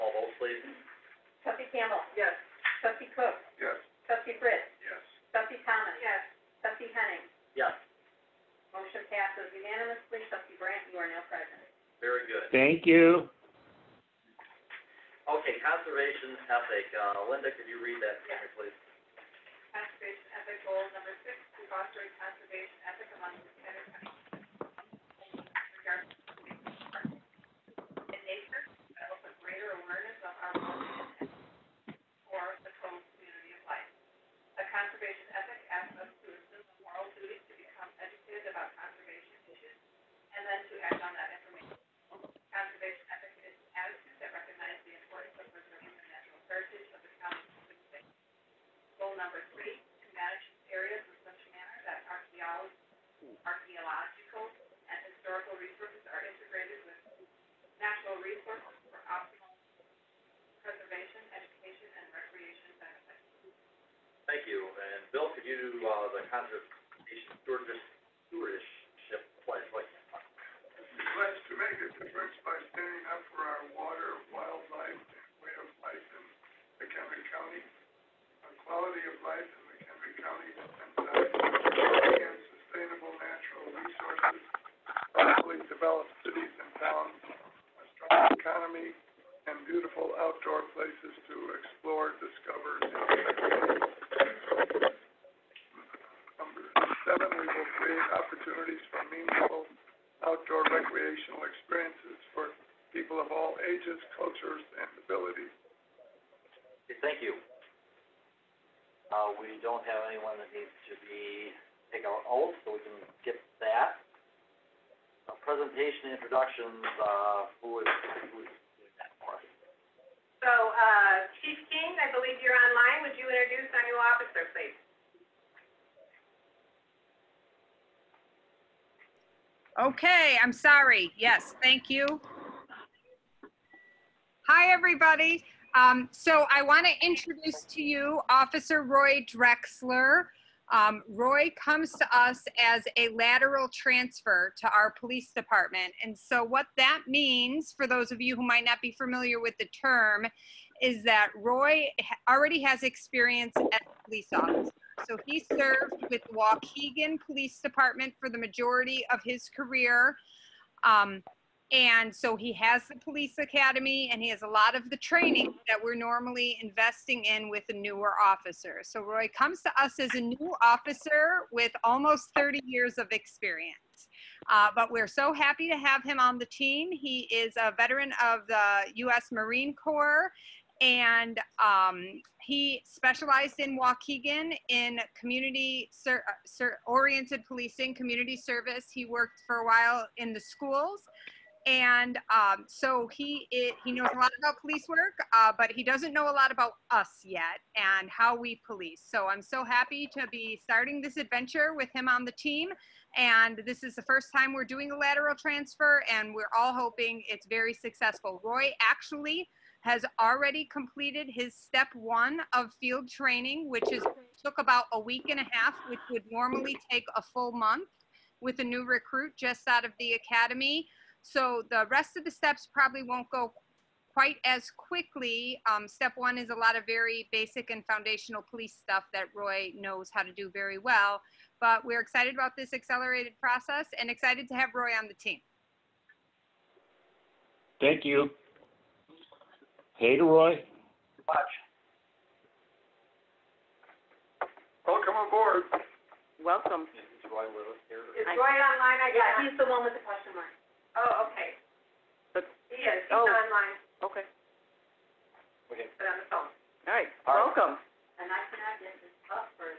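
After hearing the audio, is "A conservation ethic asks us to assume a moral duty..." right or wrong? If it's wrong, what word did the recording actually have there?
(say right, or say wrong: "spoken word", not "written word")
right.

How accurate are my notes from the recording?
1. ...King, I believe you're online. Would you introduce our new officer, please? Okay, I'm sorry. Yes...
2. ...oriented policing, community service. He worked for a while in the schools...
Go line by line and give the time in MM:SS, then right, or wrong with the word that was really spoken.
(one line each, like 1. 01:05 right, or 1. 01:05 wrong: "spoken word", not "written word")
1. 02:01 right
2. 03:06 right.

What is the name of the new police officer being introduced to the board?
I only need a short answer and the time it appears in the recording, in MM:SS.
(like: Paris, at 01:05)
Roy Drexler, at 02:18.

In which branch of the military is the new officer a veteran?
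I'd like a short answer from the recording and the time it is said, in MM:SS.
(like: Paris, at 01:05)
U.S. Marine Corps, at 02:58.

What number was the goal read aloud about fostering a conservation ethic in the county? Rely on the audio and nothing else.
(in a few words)
6.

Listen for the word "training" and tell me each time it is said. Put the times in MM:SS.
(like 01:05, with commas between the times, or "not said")
02:44, 03:33.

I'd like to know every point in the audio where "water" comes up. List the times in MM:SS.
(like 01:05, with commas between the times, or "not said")
01:13.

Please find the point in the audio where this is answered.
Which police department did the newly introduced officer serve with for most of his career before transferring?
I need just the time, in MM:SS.
02:36.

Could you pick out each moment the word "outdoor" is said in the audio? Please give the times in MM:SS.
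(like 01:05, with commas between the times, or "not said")
01:30, 01:40.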